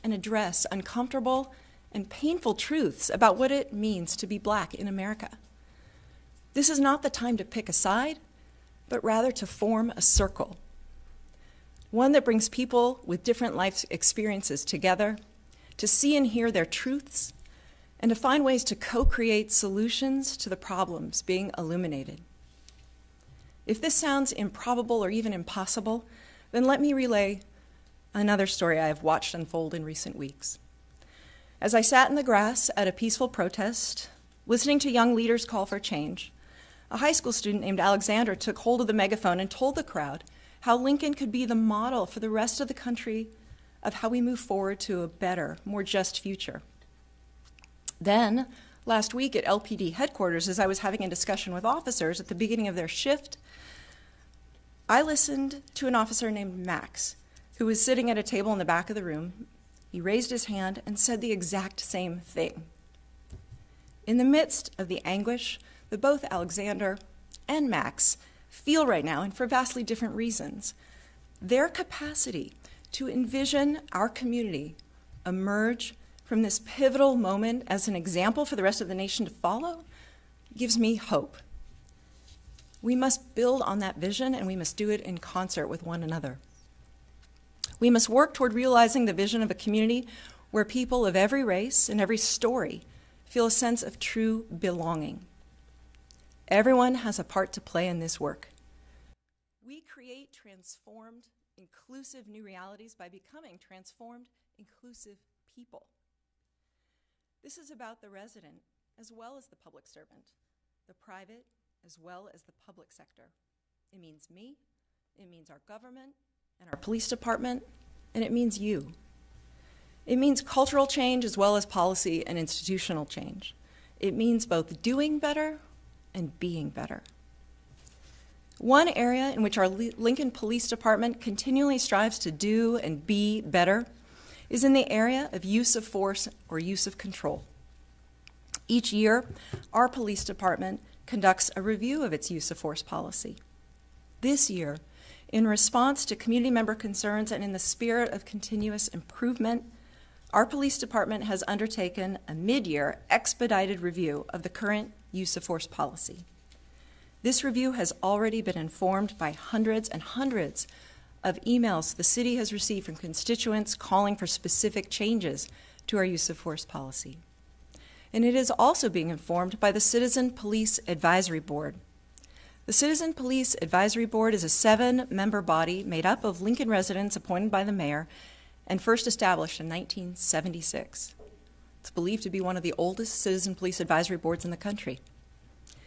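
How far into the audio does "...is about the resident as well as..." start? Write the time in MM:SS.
01:47.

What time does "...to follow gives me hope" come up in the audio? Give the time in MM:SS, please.
01:19.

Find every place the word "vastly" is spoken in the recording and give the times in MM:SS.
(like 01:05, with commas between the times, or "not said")
01:09.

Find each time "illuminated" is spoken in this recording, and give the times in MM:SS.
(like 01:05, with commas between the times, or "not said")
00:21.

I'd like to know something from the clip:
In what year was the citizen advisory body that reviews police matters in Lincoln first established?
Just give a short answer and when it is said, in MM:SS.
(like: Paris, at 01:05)
1976, at 02:59.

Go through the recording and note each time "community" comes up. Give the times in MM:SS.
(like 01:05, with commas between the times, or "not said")
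01:14, 01:29, 02:26.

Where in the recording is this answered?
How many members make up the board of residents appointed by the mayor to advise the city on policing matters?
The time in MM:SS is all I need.
02:54.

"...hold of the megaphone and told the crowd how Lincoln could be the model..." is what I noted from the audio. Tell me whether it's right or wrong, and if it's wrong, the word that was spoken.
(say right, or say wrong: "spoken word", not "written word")
right.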